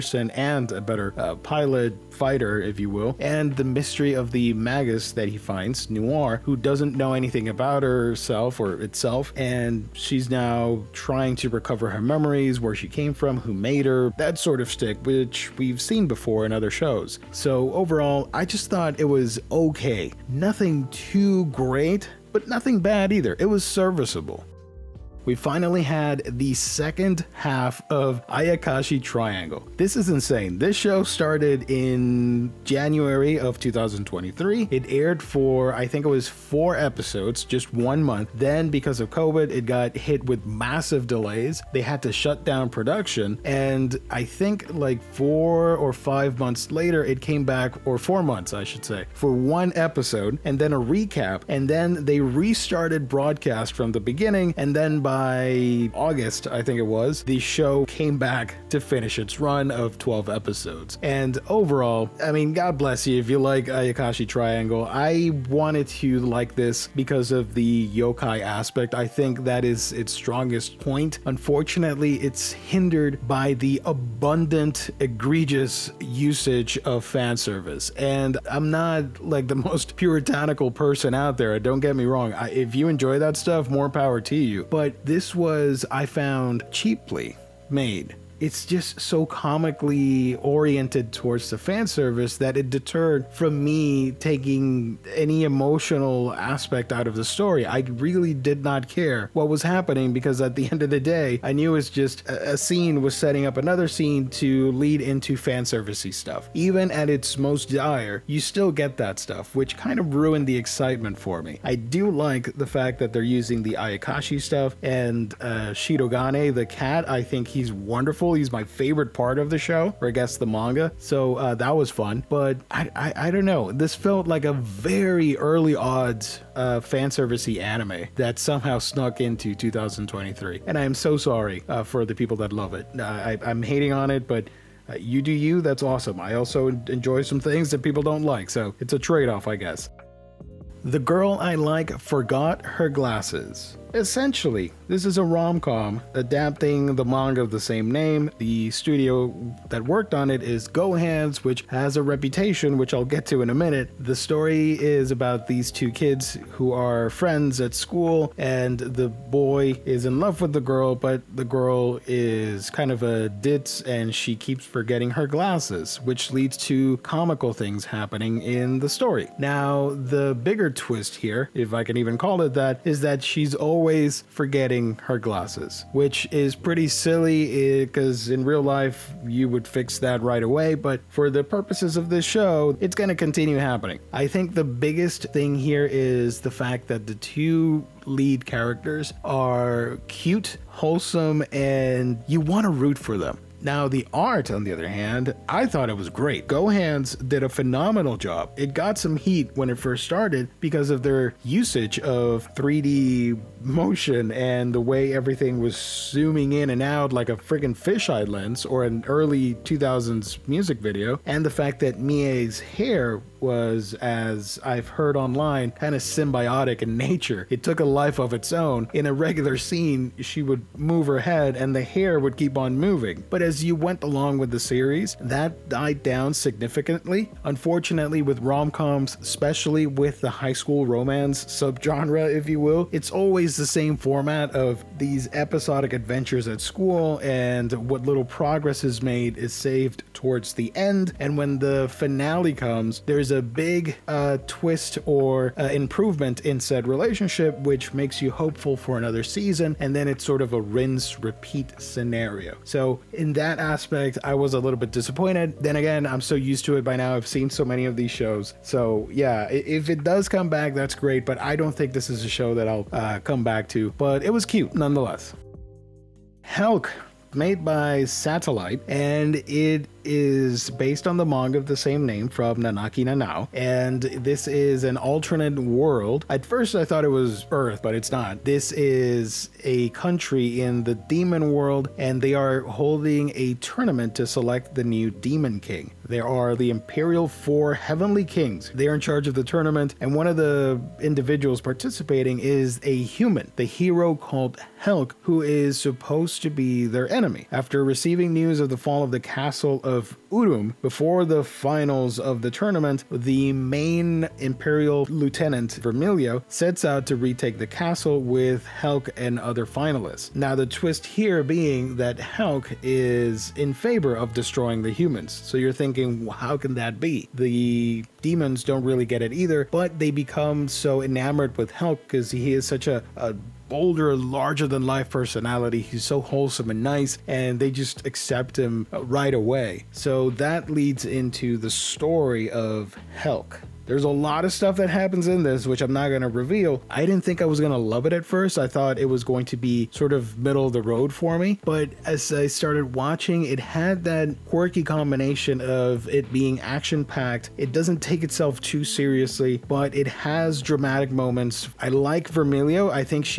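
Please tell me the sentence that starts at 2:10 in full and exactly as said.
And I am so sorry uh, for the people that love it.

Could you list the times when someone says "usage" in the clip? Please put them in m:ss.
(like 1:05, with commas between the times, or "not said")
1:16, 3:21.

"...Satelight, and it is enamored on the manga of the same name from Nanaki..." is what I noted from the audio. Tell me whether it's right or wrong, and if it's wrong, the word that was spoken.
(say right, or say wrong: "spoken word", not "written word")
wrong: "based", not "enamored".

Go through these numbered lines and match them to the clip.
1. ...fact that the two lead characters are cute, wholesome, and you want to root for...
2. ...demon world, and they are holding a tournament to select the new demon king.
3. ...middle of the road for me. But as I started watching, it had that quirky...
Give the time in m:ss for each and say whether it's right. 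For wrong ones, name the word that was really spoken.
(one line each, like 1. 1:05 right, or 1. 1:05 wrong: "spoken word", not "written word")
1. 3:06 right
2. 4:40 right
3. 5:40 right.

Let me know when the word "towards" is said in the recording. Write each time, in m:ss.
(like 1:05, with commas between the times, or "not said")
1:31, 4:00.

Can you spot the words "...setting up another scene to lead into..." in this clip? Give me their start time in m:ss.
1:43.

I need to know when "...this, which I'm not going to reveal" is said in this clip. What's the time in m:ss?
5:35.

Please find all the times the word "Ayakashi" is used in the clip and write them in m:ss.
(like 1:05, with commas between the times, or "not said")
0:28, 1:03, 1:53.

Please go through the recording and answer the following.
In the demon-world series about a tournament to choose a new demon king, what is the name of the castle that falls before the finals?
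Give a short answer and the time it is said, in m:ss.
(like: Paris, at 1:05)
Urum, at 5:00.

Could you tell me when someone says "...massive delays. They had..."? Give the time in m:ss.
0:40.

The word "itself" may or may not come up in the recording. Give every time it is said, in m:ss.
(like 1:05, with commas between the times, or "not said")
0:08, 5:48.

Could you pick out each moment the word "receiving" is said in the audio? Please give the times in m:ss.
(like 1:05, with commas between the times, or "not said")
4:57.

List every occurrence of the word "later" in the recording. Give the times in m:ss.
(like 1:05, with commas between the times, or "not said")
0:46.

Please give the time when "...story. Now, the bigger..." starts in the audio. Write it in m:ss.
2:48.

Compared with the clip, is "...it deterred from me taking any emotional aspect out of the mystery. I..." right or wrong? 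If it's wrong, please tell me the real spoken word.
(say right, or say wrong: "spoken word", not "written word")
wrong: "story", not "mystery".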